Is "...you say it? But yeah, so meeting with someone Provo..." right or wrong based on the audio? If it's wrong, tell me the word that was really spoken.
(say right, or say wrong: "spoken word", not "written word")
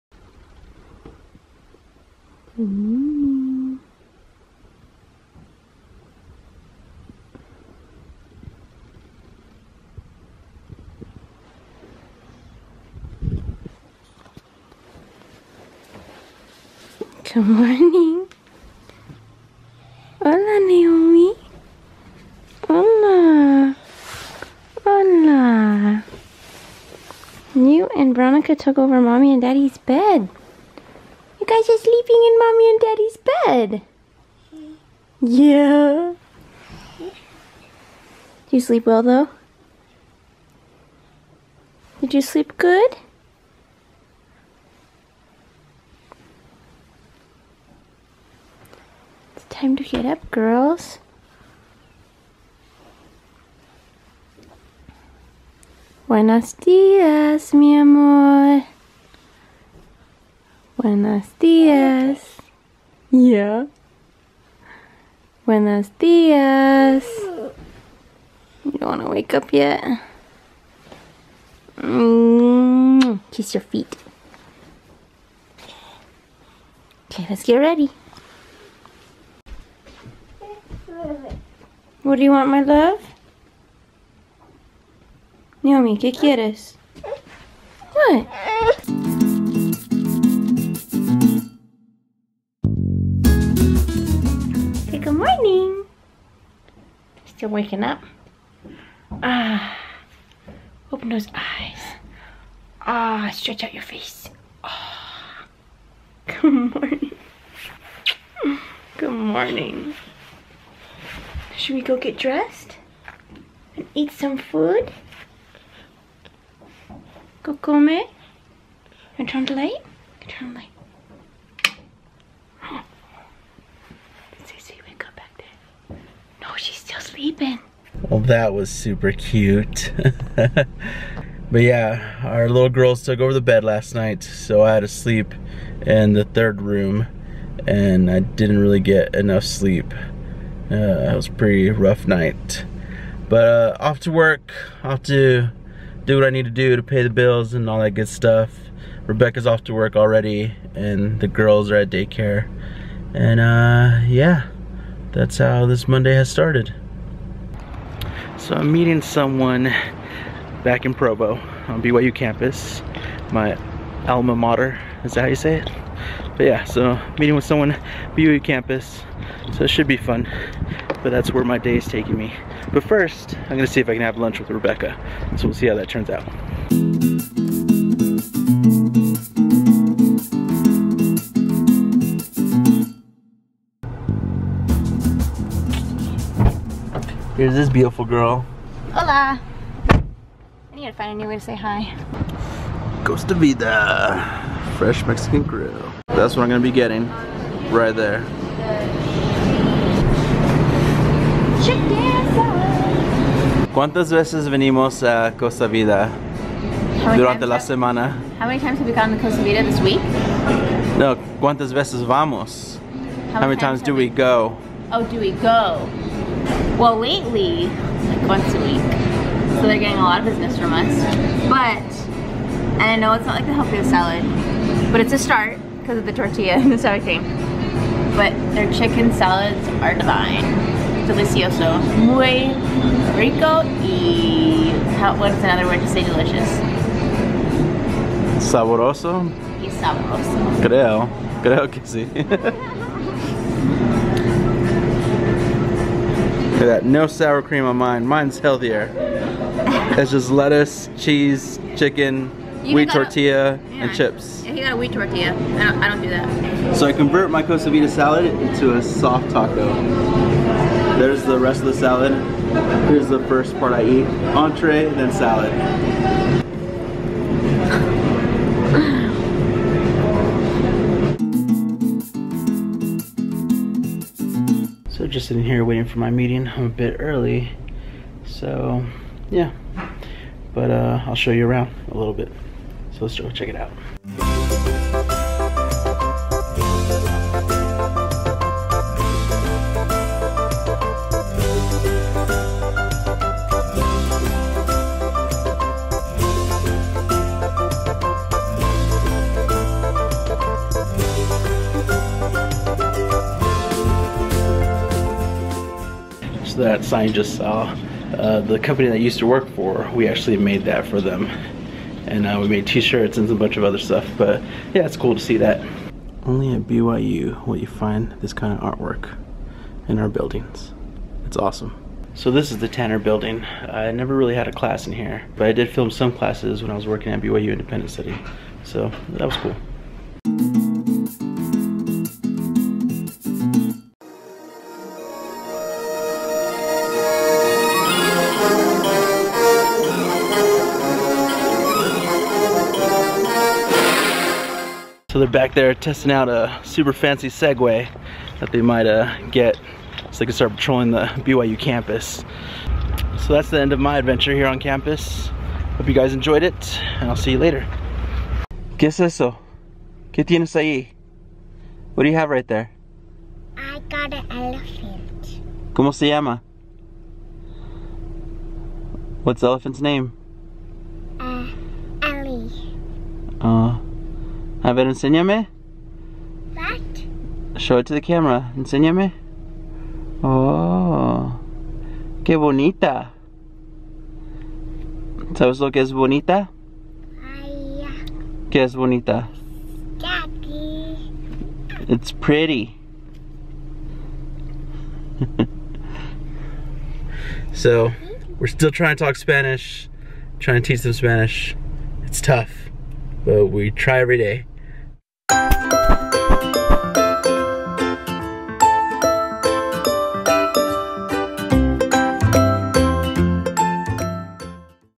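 wrong: "BYU", not "Provo".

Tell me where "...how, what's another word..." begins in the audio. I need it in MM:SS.
03:54.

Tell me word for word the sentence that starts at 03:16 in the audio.
That's what I'm gonna be getting.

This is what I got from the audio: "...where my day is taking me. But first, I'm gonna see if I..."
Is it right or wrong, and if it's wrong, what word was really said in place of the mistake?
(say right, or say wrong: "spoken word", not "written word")
right.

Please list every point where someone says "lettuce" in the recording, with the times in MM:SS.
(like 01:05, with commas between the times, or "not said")
04:10.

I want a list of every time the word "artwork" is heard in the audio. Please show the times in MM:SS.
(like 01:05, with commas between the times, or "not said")
05:18.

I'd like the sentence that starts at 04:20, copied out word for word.
There's the rest of the salad.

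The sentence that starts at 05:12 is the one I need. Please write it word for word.
And uh, we made t-shirts and a bunch of other stuff, but yeah, it's cool to see that.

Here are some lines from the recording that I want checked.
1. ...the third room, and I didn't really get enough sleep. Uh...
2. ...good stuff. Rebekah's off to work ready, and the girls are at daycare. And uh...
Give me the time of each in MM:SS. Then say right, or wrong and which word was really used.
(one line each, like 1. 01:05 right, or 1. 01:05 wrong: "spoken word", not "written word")
1. 02:16 right
2. 02:27 wrong: "already", not "ready".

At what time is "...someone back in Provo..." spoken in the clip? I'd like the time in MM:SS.
02:39.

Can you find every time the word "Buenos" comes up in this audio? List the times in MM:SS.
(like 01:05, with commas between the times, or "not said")
00:56, 01:00, 01:05.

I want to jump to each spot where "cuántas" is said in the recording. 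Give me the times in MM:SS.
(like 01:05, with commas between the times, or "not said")
03:23, 03:31.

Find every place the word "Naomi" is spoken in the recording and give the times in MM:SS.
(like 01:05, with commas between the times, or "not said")
00:20, 01:25.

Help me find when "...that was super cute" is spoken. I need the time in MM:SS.
02:08.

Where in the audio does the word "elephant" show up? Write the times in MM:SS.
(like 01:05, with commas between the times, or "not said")
06:04, 06:09.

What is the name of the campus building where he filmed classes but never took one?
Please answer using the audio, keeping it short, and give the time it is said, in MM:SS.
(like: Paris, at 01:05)
Tanner building, at 05:22.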